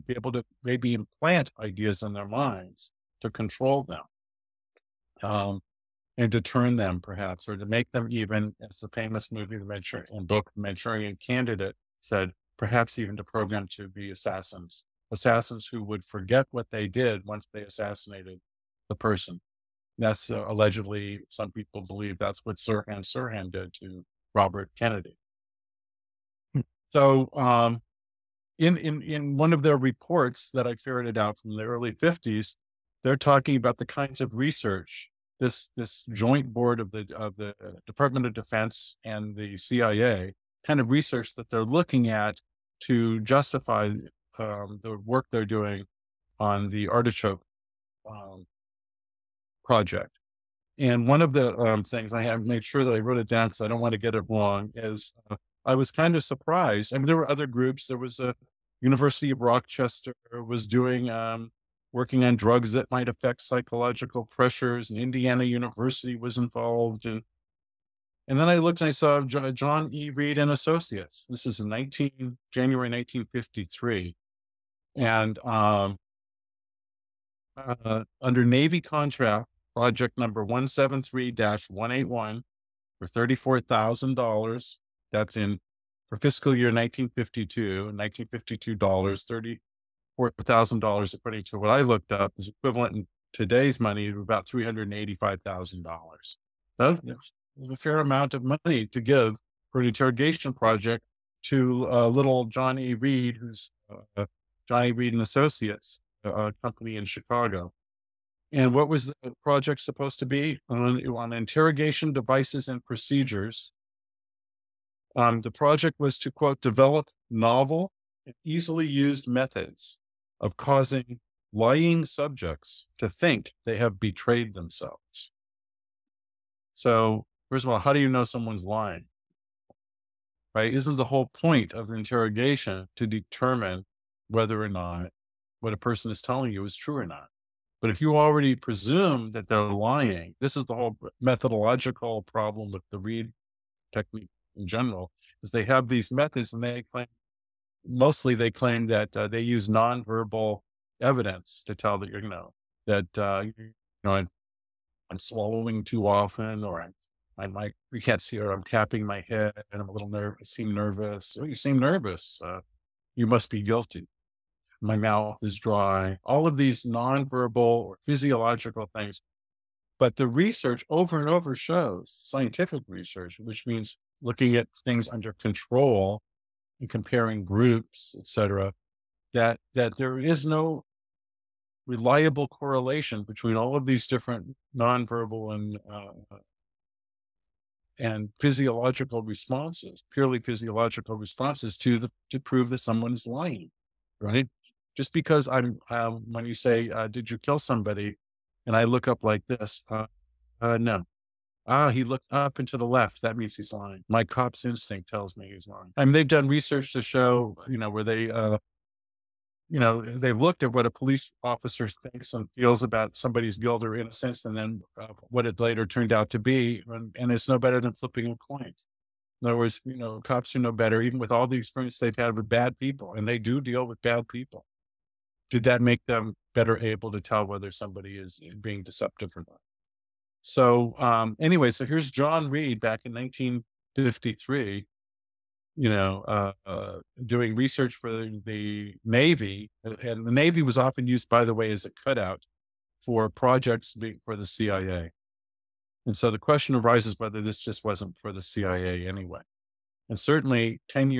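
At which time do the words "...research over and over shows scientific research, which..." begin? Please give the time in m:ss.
2:50.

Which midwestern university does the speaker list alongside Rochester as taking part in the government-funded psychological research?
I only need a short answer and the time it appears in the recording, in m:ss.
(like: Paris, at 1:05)
Indiana University, at 1:04.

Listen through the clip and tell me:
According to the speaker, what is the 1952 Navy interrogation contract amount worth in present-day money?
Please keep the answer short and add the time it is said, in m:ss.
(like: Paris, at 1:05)
$385,000, at 1:34.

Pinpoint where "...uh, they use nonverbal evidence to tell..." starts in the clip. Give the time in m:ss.
2:29.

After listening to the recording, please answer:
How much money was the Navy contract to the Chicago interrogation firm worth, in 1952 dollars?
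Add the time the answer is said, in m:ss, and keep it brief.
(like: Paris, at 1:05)
$34,000, at 1:23.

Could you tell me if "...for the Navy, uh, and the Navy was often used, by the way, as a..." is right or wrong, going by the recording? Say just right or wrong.
right.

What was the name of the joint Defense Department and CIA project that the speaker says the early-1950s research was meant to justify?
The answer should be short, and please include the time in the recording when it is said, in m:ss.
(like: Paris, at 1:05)
Artichoke, at 0:46.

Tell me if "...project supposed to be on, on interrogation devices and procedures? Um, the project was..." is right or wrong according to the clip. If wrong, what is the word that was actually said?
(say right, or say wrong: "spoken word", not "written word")
right.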